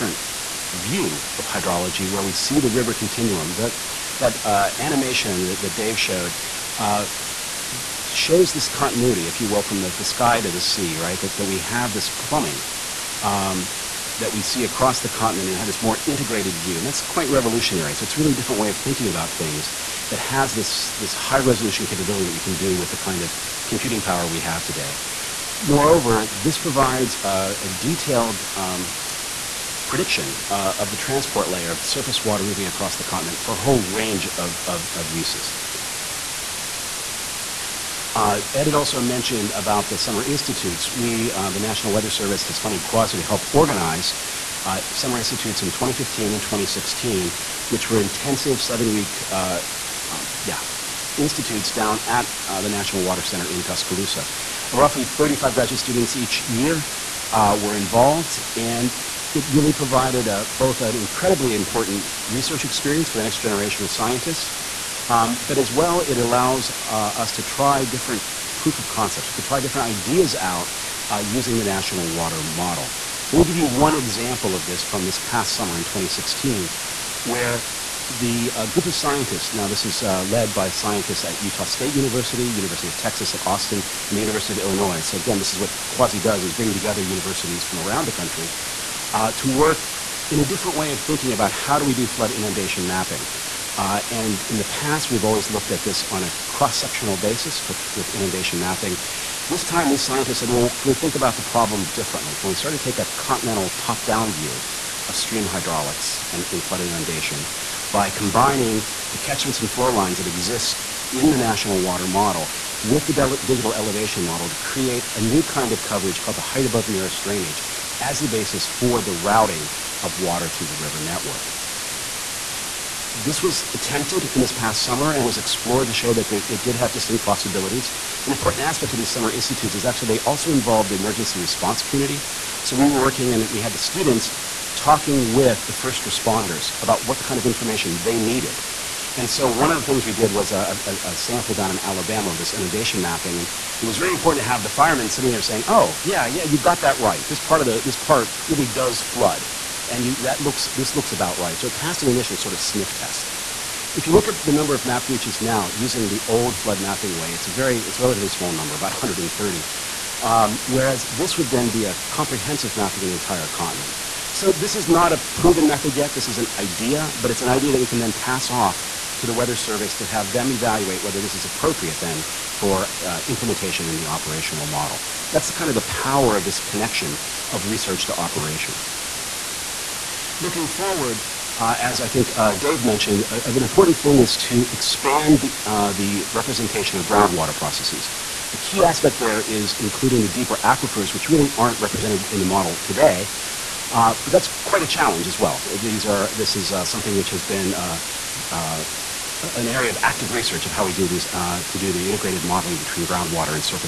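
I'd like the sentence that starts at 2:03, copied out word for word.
This was attempted in this past summer and was explored to show that there, it did have distinct possibilities.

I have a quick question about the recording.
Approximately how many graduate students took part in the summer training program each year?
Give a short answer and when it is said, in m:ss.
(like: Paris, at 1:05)
35, at 0:55.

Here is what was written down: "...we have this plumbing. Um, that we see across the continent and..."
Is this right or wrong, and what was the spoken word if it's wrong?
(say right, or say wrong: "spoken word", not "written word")
right.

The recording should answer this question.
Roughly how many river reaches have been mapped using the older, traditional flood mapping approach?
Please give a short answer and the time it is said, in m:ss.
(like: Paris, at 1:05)
130, at 2:38.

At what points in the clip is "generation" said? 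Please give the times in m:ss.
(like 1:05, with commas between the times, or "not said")
1:03.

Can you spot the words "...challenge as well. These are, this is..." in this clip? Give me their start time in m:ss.
3:14.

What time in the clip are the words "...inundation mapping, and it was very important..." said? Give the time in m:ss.
2:22.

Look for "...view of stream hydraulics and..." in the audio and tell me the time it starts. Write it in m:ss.
1:44.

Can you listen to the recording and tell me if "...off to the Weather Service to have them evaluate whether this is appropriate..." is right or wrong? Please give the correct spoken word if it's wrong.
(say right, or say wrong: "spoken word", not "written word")
right.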